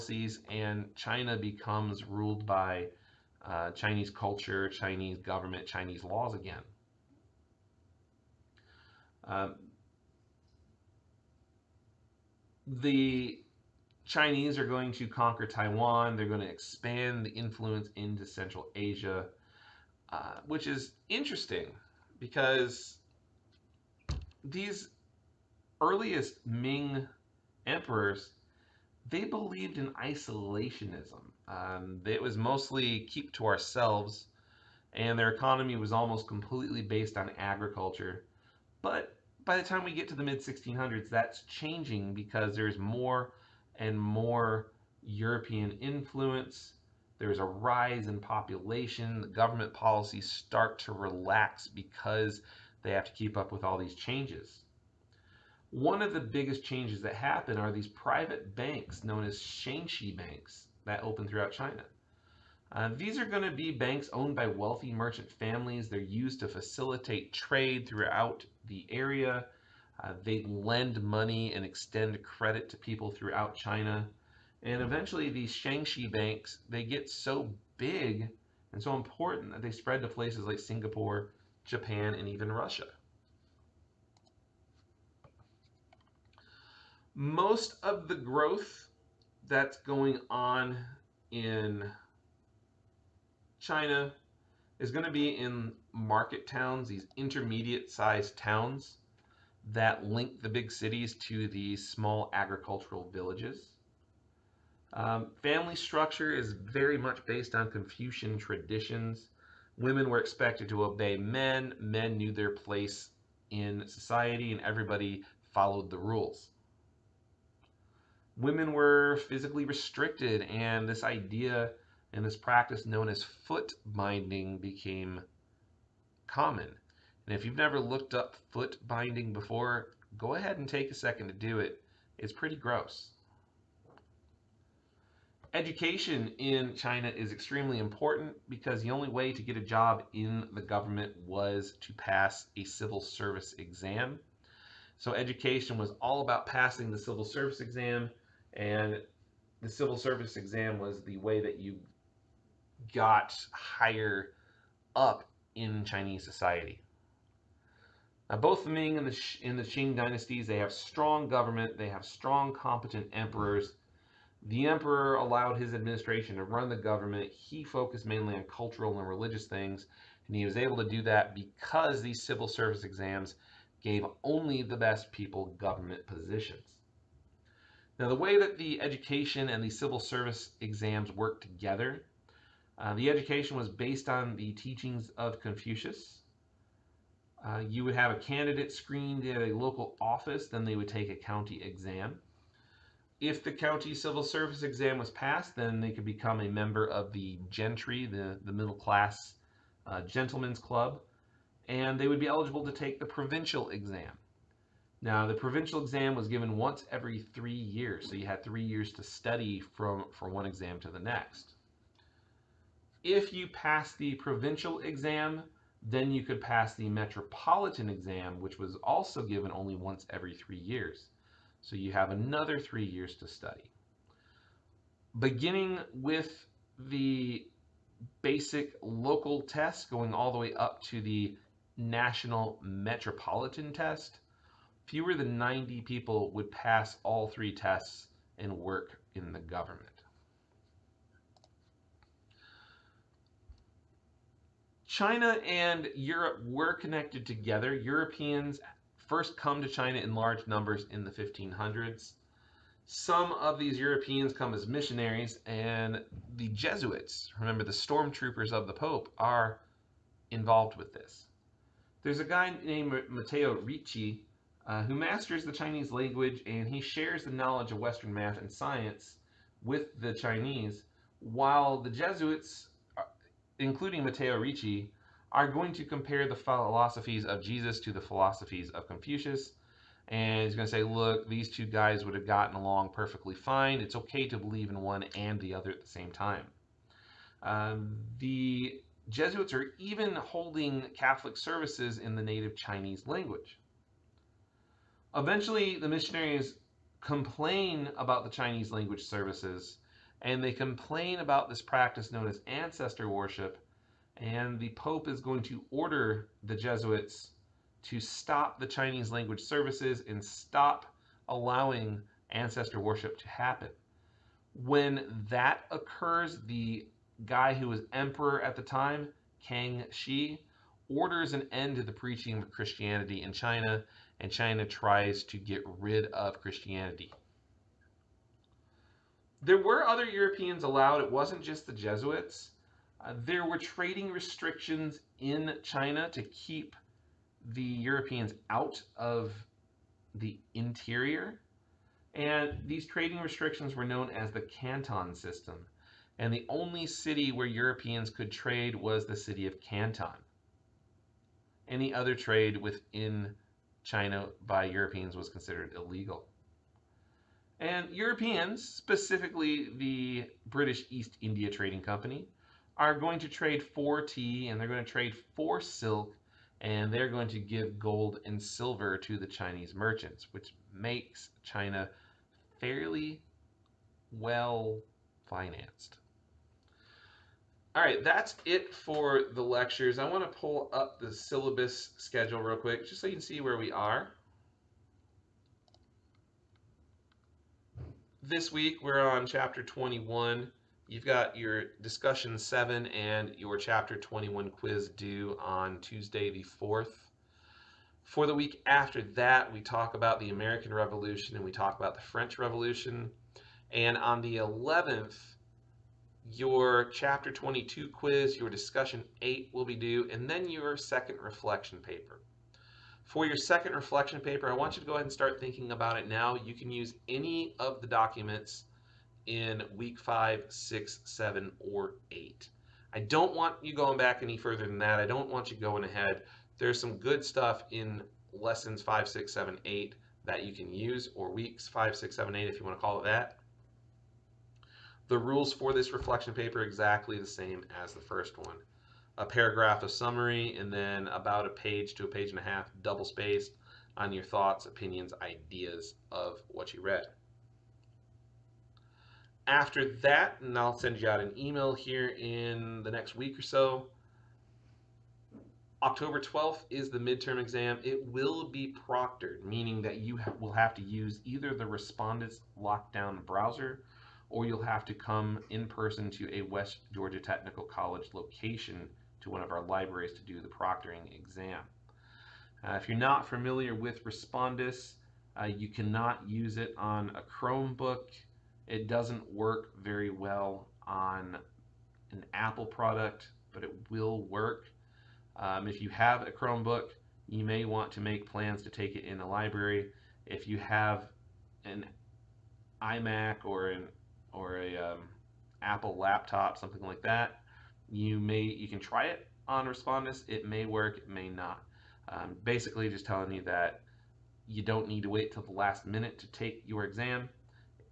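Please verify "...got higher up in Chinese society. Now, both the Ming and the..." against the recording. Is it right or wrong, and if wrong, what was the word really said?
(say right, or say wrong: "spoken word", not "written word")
right.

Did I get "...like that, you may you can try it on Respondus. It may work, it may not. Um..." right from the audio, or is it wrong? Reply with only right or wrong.
right.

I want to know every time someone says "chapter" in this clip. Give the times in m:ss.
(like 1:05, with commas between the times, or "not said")
6:29, 6:33, 6:46.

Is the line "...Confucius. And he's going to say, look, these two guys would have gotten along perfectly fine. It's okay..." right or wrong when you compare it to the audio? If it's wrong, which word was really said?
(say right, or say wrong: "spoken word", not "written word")
right.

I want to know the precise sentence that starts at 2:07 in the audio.
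And if you've never looked up foot binding before, go ahead and take a second to do it.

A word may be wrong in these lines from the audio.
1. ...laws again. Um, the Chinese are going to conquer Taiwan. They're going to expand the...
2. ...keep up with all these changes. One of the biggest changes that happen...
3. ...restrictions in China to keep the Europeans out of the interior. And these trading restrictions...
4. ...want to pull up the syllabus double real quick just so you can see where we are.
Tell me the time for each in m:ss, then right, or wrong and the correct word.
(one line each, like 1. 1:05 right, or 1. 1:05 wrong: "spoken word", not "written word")
1. 0:06 right
2. 0:53 right
3. 5:34 right
4. 6:20 wrong: "schedule", not "double".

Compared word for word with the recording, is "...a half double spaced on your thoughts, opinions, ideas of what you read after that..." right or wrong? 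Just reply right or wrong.
right.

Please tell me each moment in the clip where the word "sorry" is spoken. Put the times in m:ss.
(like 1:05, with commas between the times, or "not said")
not said.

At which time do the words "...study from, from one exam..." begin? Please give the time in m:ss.
3:29.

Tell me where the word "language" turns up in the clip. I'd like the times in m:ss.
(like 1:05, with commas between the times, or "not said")
4:25, 4:53, 4:58, 5:09.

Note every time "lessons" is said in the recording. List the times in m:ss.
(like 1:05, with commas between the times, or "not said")
7:08.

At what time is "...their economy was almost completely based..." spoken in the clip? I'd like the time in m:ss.
0:35.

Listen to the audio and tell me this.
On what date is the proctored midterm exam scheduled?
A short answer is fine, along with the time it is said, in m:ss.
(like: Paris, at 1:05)
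October 12th, at 7:35.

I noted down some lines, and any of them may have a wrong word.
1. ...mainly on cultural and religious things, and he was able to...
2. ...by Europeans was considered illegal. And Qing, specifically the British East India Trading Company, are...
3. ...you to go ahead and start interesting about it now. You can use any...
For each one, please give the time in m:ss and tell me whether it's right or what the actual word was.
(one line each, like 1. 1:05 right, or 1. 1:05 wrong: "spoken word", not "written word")
1. 2:48 right
2. 5:54 wrong: "Europeans", not "Qing"
3. 6:54 wrong: "thinking", not "interesting".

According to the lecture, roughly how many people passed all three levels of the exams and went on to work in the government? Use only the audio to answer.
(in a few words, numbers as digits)
fewer than 90.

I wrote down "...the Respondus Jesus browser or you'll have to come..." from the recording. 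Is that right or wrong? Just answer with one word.
wrong.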